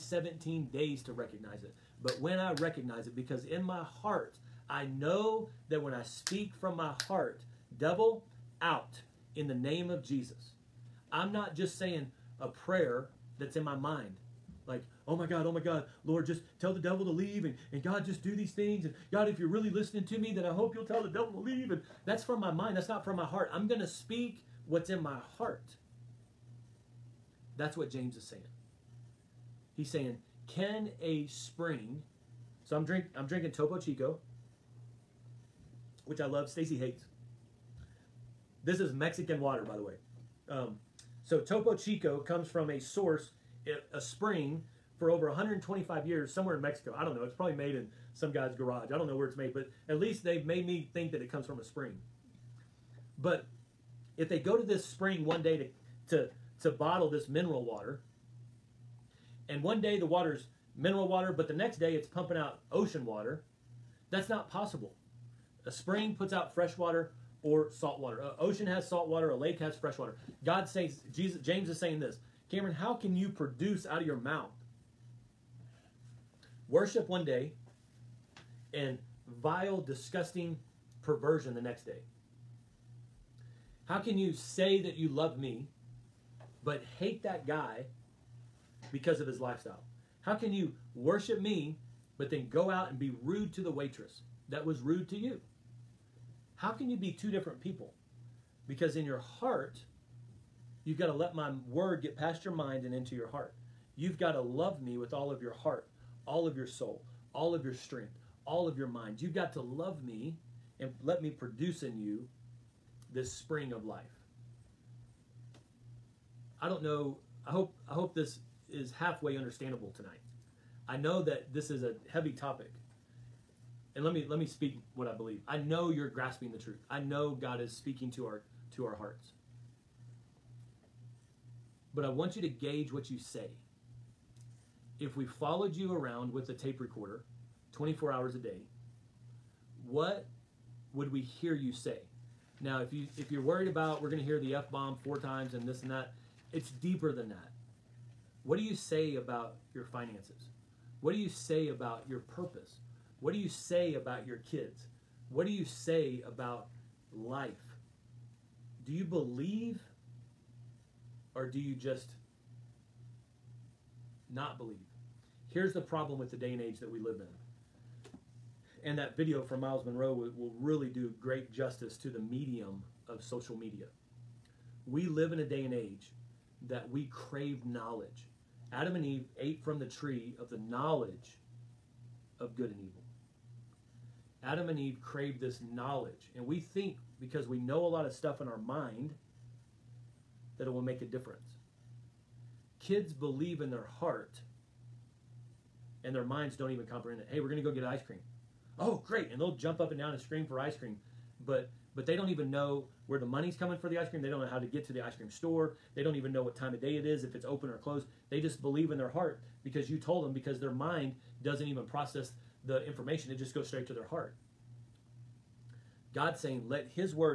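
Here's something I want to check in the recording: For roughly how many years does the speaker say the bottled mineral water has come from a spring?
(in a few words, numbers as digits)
125.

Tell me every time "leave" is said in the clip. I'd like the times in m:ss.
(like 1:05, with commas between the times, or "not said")
0:17, 0:21.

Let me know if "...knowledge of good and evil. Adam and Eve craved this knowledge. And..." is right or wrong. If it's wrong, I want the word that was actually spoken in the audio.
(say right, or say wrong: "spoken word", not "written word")
right.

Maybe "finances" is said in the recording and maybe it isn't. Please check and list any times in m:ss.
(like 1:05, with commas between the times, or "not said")
2:29.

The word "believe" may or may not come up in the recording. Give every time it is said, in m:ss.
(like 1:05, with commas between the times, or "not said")
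2:05, 2:39, 2:44, 3:13, 3:28.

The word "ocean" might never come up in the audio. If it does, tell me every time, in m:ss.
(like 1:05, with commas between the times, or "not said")
1:02, 1:08.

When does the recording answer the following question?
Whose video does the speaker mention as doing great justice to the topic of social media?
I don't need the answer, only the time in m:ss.
2:49.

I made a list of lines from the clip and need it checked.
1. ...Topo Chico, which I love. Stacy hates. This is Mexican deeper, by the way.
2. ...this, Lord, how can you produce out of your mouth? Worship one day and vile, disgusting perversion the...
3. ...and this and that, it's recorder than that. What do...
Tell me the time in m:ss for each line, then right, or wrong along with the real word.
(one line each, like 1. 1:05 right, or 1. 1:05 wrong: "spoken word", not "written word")
1. 0:33 wrong: "water", not "deeper"
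2. 1:11 wrong: "Cameron", not "Lord"
3. 2:25 wrong: "deeper", not "recorder".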